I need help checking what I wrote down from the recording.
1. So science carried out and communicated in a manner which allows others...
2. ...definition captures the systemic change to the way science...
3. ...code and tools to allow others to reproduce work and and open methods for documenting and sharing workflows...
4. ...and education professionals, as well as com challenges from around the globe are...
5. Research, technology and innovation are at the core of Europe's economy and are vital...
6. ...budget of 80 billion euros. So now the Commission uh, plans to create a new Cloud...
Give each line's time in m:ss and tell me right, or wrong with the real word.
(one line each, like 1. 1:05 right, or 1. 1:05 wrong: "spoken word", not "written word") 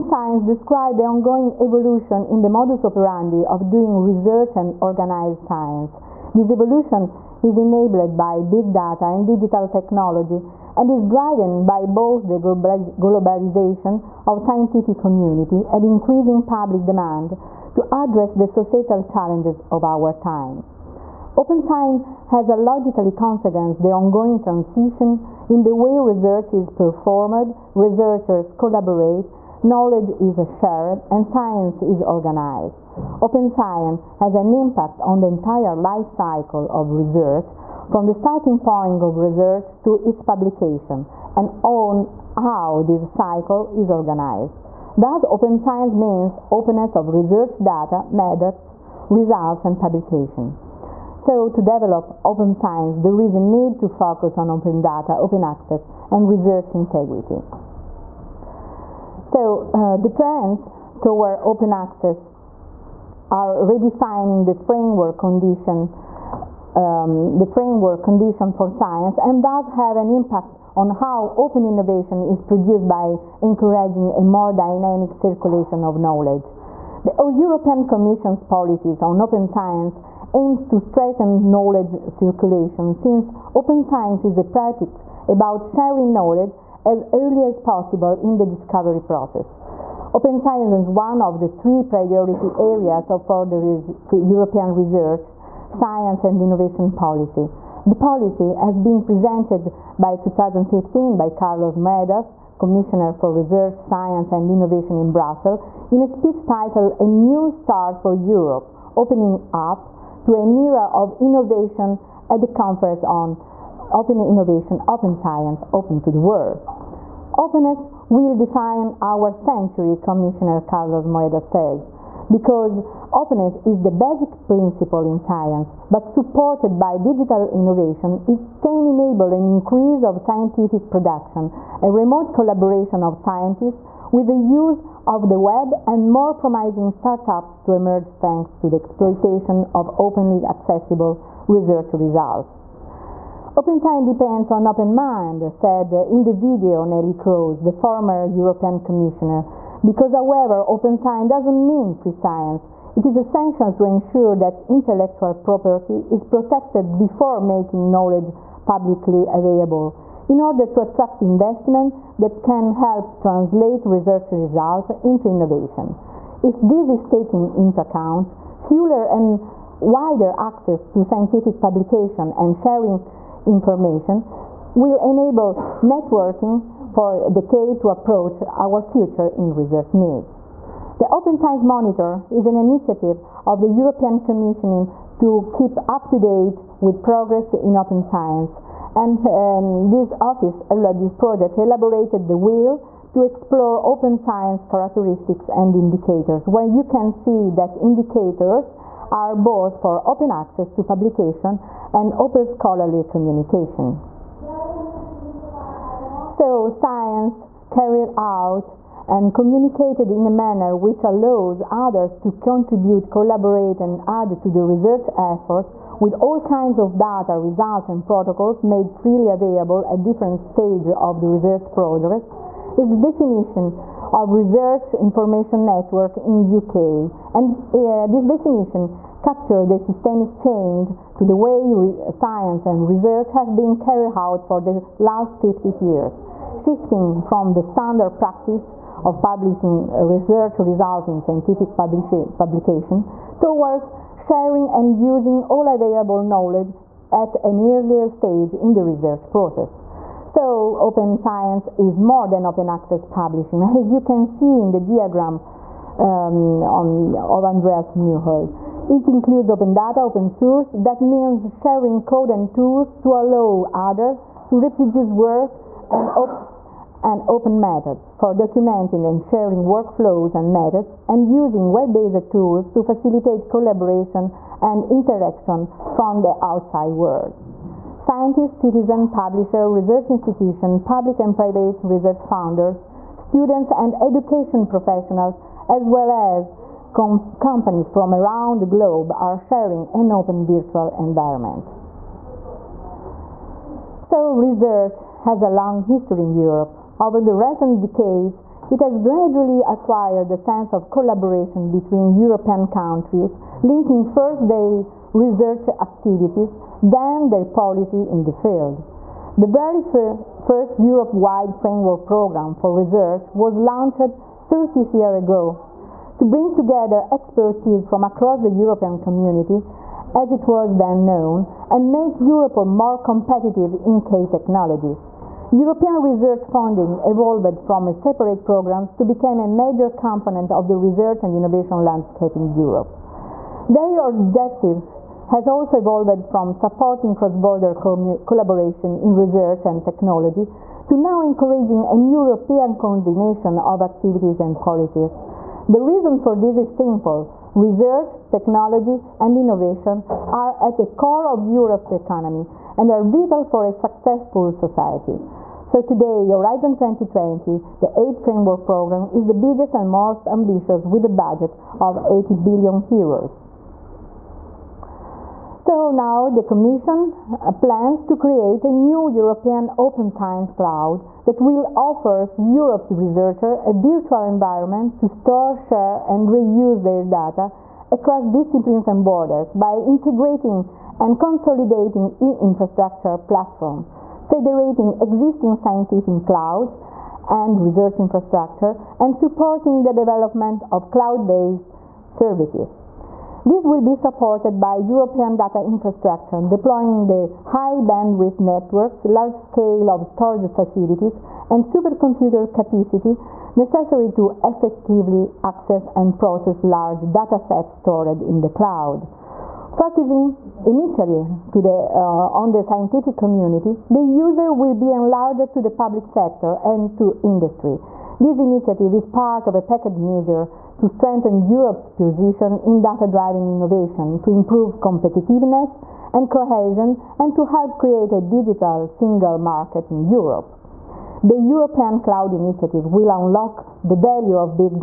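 1. 3:26 right
2. 3:48 right
3. 4:22 right
4. 4:43 wrong: "companies", not "challenges"
5. 5:47 right
6. 6:01 wrong: "European", not "Cloud".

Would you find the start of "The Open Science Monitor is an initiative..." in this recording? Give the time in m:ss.
3:00.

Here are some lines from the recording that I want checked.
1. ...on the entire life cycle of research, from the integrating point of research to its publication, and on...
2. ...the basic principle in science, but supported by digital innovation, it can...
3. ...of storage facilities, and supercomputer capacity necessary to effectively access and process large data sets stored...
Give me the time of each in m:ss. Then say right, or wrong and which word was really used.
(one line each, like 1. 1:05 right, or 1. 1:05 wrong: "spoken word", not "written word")
1. 0:34 wrong: "starting", not "integrating"
2. 2:03 right
3. 6:39 right.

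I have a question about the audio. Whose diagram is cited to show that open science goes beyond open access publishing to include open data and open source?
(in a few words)
Andreas Neuhold.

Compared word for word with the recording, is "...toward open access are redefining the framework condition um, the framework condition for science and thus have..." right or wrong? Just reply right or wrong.
right.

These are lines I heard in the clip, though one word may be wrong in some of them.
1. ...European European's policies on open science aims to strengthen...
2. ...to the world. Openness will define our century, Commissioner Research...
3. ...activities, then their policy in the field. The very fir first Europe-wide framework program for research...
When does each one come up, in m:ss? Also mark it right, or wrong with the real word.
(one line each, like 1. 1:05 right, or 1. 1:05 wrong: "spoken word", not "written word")
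1. 1:17 wrong: "Commission", not "European"
2. 1:55 wrong: "Carlos", not "Research"
3. 5:05 right.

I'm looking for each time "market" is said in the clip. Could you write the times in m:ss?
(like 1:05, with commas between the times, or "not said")
7:09.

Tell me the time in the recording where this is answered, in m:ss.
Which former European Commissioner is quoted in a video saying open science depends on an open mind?
2:26.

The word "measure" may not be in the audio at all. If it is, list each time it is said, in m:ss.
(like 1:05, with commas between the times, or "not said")
6:59.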